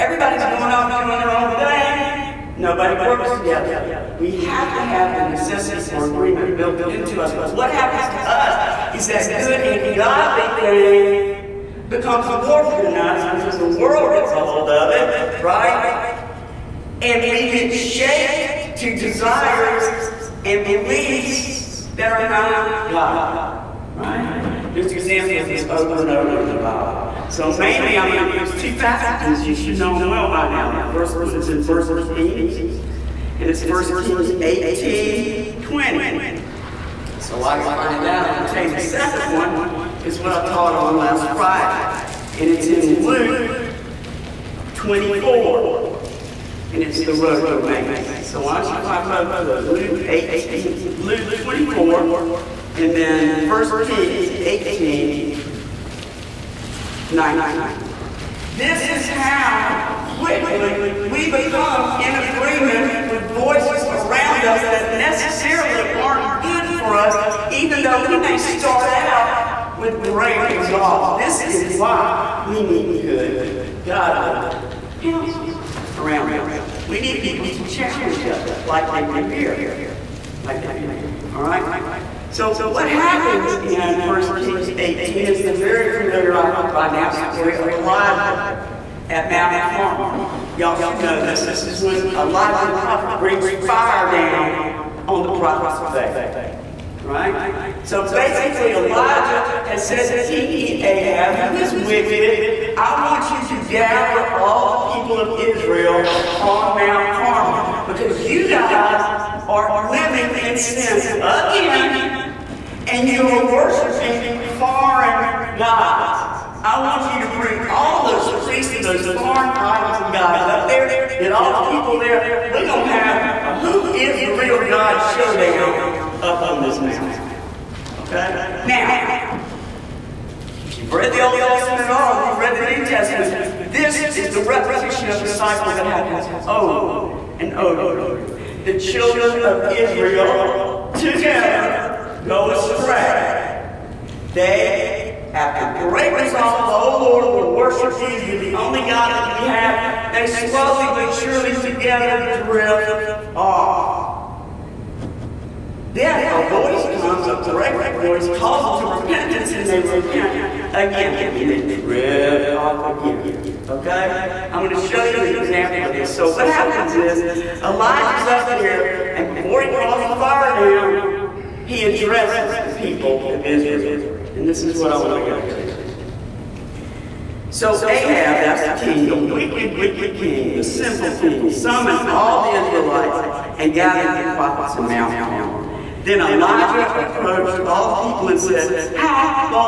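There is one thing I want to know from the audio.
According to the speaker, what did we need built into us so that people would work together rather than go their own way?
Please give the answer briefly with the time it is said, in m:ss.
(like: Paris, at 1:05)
The necessity for agreement, at 0:05.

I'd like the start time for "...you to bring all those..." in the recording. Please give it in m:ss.
1:57.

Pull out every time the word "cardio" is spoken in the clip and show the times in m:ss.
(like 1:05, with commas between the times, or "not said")
not said.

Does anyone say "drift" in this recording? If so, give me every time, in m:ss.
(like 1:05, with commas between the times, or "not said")
2:32, 2:41.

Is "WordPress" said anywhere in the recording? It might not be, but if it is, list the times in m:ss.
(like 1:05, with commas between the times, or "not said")
not said.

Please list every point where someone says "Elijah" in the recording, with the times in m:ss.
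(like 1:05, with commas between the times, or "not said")
1:27, 1:32, 1:38, 2:47, 3:06.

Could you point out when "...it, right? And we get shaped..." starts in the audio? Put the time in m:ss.
0:14.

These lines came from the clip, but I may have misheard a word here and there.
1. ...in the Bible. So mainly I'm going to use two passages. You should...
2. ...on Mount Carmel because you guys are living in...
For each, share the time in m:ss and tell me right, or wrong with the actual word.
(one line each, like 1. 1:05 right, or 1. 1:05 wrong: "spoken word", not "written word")
1. 0:26 right
2. 1:46 right.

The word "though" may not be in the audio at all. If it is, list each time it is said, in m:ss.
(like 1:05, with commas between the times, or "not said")
1:07.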